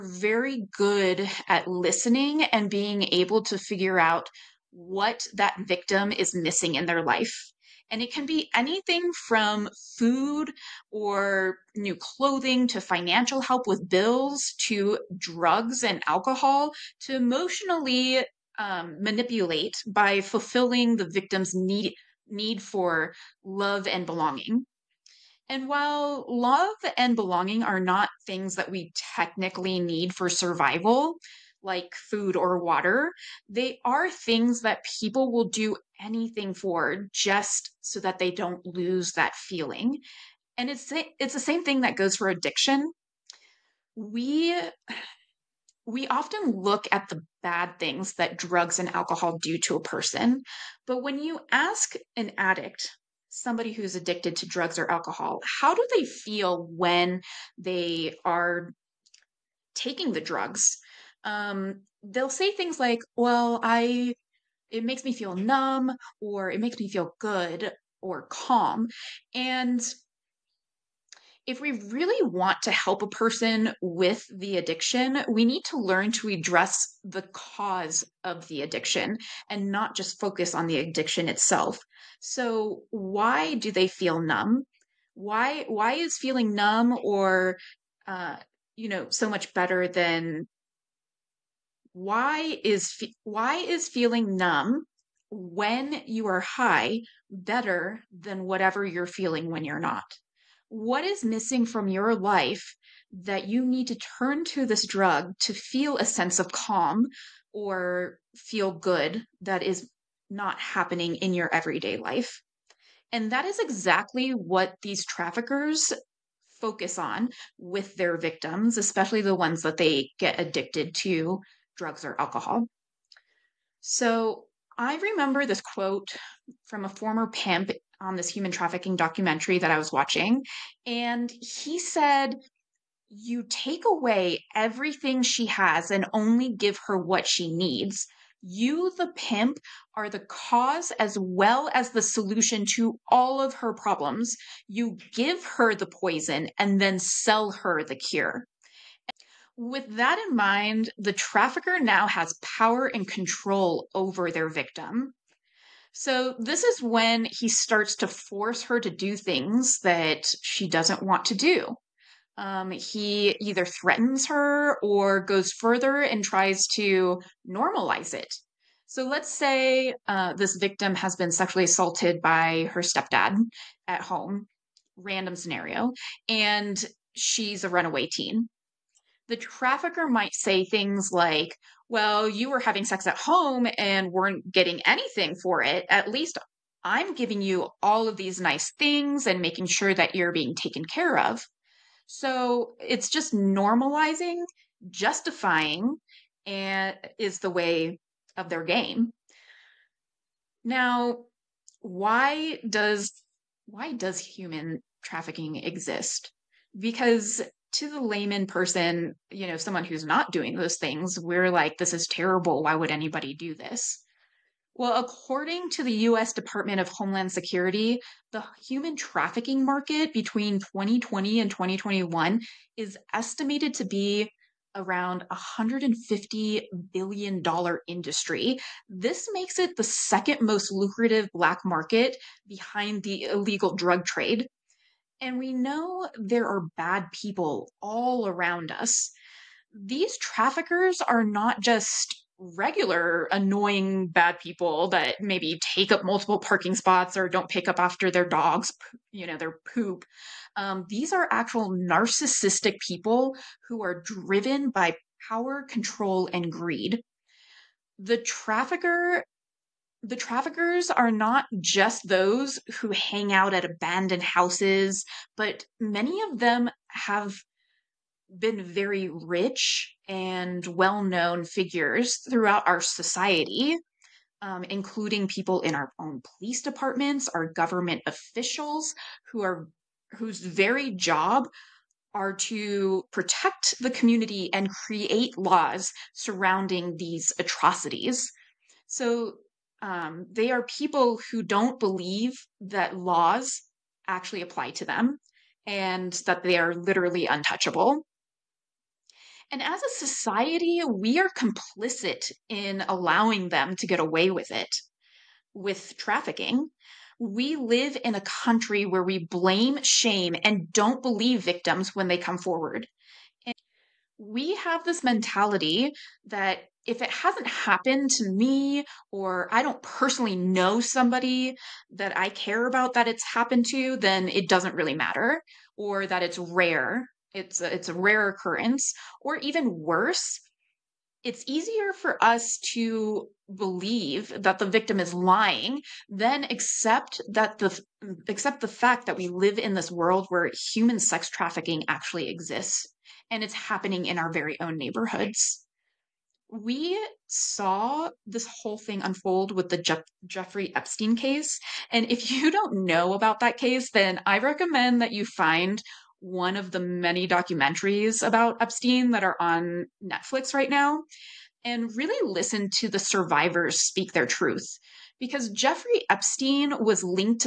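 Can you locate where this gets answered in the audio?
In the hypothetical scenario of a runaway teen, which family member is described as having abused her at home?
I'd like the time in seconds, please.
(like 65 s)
172 s.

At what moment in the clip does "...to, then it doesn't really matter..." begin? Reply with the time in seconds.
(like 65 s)
323 s.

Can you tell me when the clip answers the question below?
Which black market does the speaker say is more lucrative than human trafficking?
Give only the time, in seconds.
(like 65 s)
233 s.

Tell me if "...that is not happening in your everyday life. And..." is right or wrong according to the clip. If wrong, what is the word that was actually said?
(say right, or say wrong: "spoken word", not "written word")
right.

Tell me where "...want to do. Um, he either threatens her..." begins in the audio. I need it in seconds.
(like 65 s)
161 s.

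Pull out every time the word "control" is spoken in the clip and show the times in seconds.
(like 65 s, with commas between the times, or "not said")
153 s, 255 s.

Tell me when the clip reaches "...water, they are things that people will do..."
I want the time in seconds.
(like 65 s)
32 s.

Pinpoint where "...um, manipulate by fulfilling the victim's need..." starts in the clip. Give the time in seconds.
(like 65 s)
18 s.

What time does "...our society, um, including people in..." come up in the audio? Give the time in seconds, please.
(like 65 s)
272 s.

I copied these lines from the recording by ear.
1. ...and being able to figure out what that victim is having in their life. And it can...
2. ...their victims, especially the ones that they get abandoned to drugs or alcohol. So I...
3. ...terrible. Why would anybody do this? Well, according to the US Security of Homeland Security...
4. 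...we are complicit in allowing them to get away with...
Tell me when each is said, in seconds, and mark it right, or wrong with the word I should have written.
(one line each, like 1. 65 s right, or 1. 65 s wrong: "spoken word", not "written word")
1. 2 s wrong: "missing", not "having"
2. 117 s wrong: "addicted", not "abandoned"
3. 212 s wrong: "Department", not "Security"
4. 300 s right.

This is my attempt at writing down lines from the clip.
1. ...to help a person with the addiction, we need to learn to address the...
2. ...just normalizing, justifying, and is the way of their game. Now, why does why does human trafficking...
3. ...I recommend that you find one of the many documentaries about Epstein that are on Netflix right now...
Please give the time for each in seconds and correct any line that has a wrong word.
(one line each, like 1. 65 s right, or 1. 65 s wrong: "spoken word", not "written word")
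1. 72 s right
2. 193 s right
3. 354 s right.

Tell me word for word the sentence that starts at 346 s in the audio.
We saw this whole thing unfold with the Jeffrey Epstein case.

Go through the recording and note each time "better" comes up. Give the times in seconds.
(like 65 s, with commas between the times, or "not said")
89 s, 97 s.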